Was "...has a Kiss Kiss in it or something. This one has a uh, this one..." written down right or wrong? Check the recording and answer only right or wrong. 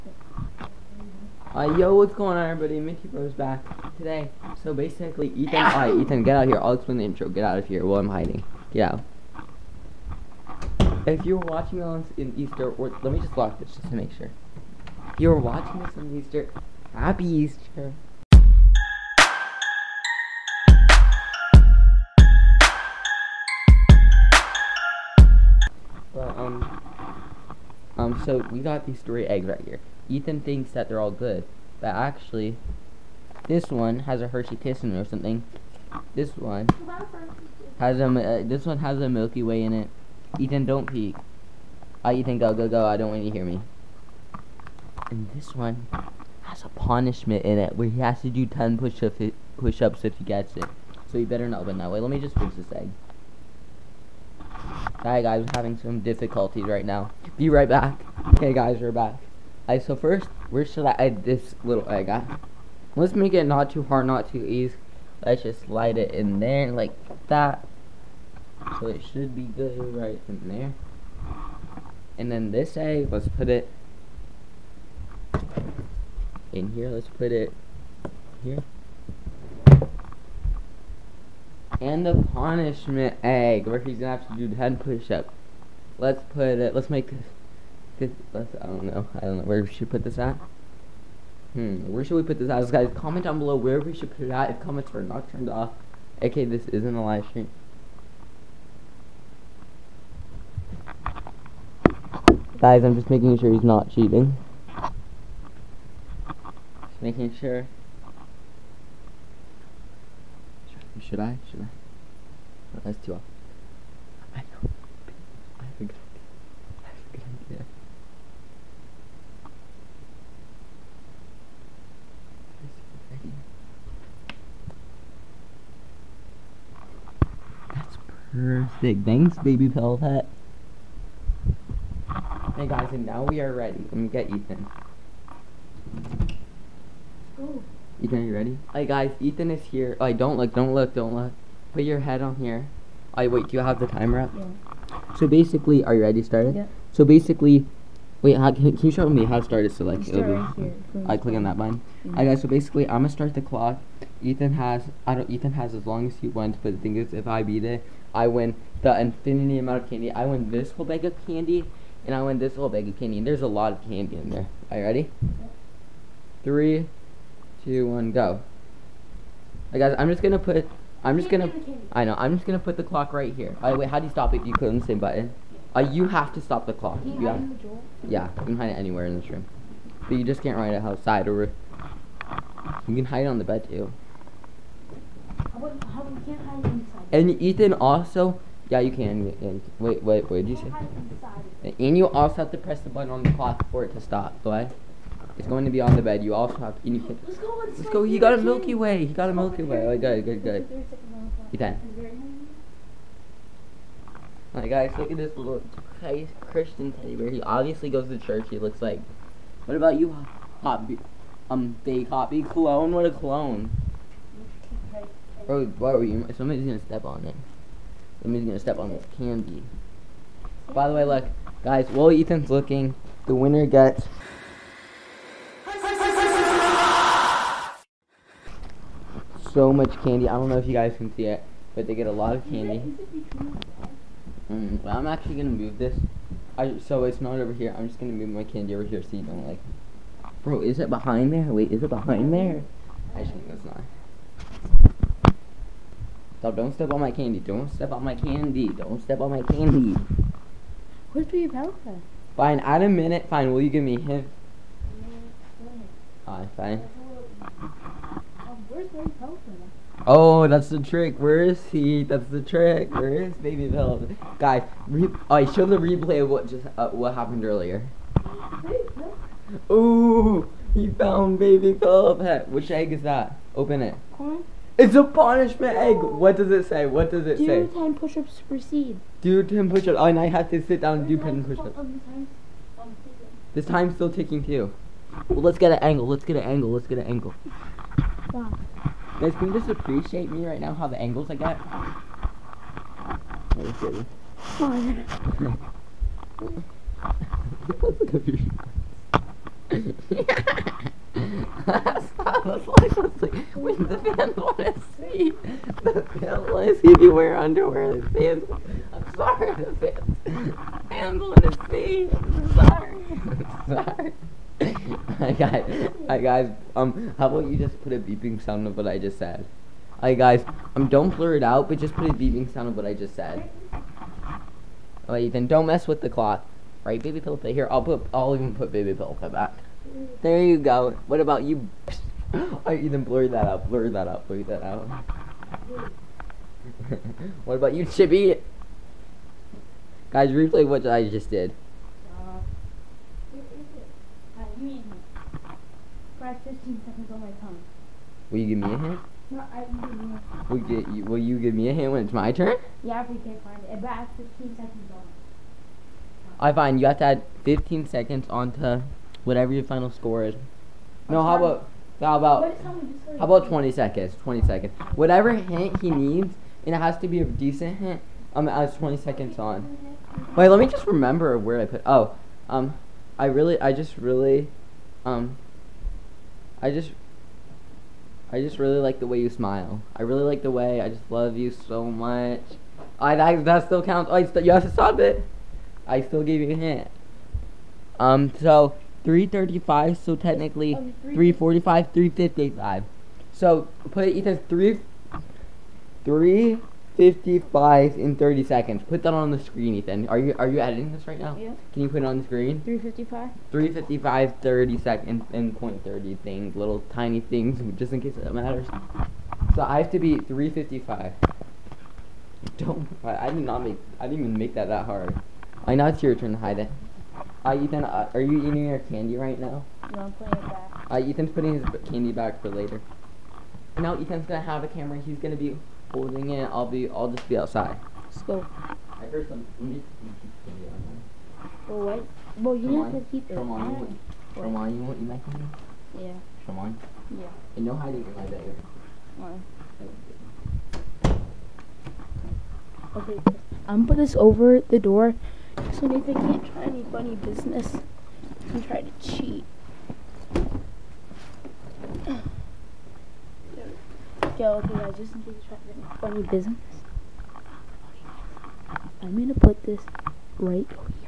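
wrong.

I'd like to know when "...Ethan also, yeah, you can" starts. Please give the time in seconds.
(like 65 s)
187 s.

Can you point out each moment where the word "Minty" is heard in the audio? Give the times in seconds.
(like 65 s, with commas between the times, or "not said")
2 s.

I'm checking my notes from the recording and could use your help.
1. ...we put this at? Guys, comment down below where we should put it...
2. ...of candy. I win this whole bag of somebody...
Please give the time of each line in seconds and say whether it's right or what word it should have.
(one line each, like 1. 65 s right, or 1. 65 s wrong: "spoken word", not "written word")
1. 92 s right
2. 159 s wrong: "candy", not "somebody".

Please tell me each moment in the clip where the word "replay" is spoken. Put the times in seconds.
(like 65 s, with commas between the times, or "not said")
265 s, 340 s.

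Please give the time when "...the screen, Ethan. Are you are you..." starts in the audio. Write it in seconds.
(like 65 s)
399 s.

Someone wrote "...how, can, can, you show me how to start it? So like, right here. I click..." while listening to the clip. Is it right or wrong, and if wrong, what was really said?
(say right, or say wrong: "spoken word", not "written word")
right.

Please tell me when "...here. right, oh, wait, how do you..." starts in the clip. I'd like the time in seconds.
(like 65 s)
173 s.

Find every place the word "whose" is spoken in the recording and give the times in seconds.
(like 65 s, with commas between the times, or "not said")
not said.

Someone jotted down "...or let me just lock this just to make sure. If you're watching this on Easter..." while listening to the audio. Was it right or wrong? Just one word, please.
right.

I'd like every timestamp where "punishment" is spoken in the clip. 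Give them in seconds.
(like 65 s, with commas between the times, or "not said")
46 s, 82 s, 275 s.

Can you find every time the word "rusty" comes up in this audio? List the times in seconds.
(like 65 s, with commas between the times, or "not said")
not said.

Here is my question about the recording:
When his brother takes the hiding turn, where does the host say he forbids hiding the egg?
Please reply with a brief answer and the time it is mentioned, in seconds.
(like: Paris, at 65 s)
my bed, at 437 s.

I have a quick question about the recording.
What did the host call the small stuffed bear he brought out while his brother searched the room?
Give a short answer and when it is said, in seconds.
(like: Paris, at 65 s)
Christian teddy bear, at 206 s.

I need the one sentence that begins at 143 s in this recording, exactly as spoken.
I wait, do you have the timer up?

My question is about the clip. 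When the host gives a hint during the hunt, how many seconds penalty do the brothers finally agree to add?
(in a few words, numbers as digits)
20.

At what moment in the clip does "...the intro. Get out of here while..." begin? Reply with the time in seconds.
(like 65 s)
6 s.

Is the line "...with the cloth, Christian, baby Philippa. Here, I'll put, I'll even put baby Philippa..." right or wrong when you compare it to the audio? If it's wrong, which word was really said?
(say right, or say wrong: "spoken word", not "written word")
wrong: "Right", not "Christian".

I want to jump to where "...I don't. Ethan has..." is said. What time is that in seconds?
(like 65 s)
155 s.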